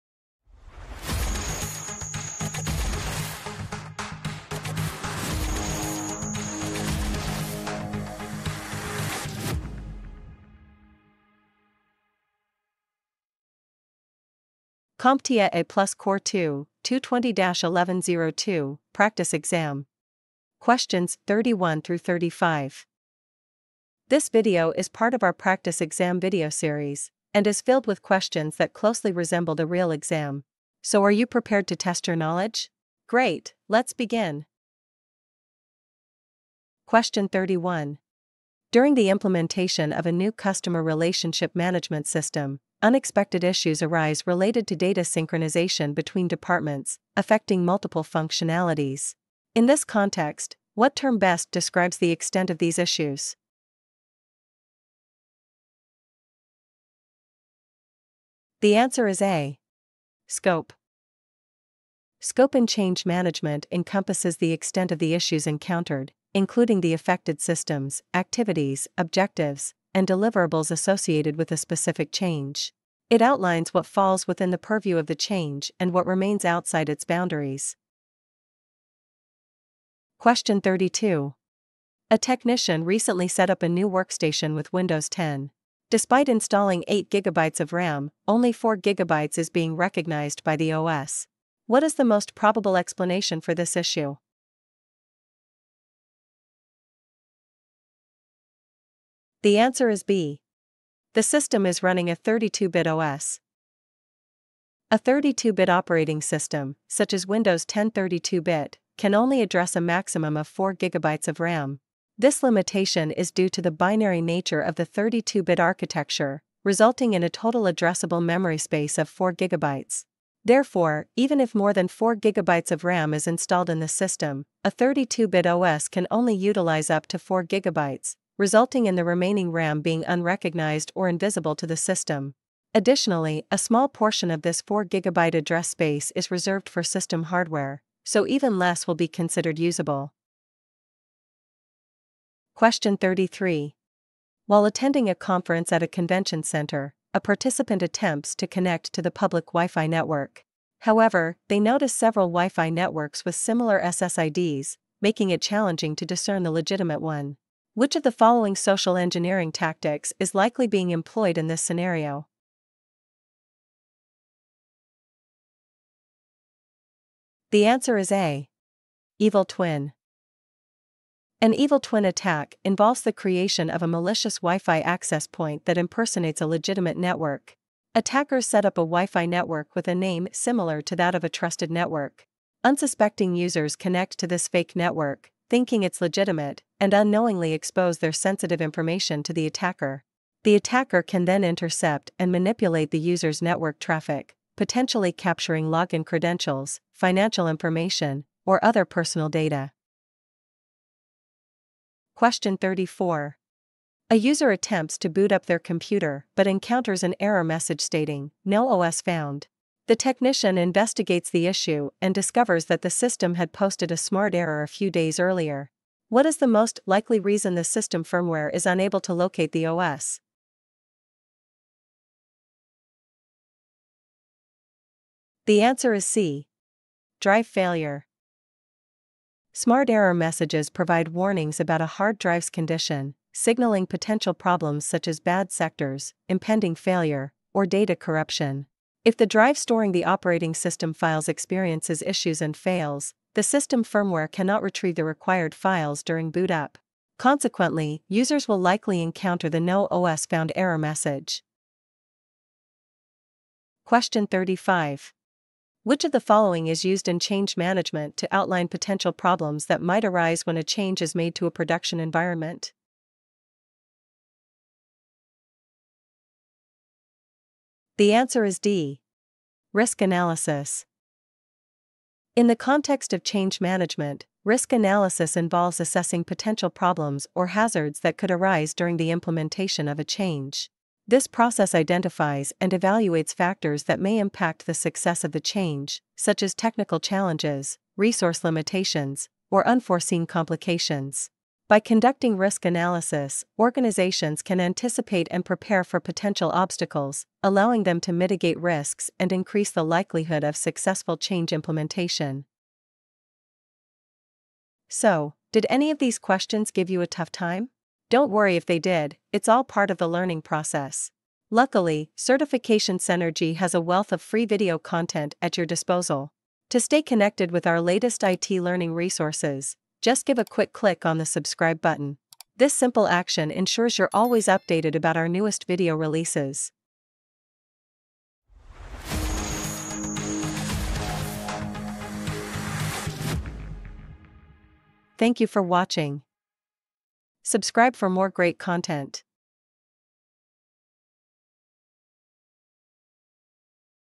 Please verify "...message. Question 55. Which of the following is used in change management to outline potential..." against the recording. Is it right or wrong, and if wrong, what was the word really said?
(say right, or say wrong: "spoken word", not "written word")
wrong: "35", not "55".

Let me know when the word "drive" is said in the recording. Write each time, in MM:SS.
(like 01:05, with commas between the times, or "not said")
03:47, 03:52, 03:59.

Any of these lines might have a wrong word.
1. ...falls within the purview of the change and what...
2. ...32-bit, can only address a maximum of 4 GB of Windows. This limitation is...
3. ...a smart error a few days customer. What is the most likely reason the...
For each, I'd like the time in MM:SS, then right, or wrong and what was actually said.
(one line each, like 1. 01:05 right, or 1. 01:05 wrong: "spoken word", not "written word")
1. 01:13 right
2. 01:47 wrong: "RAM", not "Windows"
3. 03:33 wrong: "earlier", not "customer".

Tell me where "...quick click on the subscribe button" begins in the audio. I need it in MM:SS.
05:20.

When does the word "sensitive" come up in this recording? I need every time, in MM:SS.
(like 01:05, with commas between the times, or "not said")
03:08.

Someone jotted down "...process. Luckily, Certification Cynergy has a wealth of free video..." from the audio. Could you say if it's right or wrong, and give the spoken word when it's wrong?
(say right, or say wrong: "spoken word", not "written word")
right.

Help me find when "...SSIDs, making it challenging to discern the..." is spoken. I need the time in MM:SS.
02:33.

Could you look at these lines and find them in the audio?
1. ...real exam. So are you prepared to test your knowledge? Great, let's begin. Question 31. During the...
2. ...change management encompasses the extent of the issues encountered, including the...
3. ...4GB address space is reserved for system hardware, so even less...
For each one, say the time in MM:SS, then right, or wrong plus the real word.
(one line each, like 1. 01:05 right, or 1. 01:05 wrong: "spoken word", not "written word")
1. 00:29 right
2. 01:02 right
3. 02:14 right.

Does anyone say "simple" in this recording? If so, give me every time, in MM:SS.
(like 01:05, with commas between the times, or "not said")
05:22.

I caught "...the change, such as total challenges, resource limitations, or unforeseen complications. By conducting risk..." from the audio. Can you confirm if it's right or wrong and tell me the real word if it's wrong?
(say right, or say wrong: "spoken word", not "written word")
wrong: "technical", not "total".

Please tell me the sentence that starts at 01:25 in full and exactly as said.
Despite installing 8 GB of RAM, only 4 GB is being recognized by the OS.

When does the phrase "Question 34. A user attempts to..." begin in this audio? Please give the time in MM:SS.
03:22.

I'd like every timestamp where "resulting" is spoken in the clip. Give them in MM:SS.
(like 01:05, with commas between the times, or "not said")
01:56, 02:08.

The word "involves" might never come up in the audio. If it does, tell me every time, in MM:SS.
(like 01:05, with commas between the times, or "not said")
02:52, 04:35.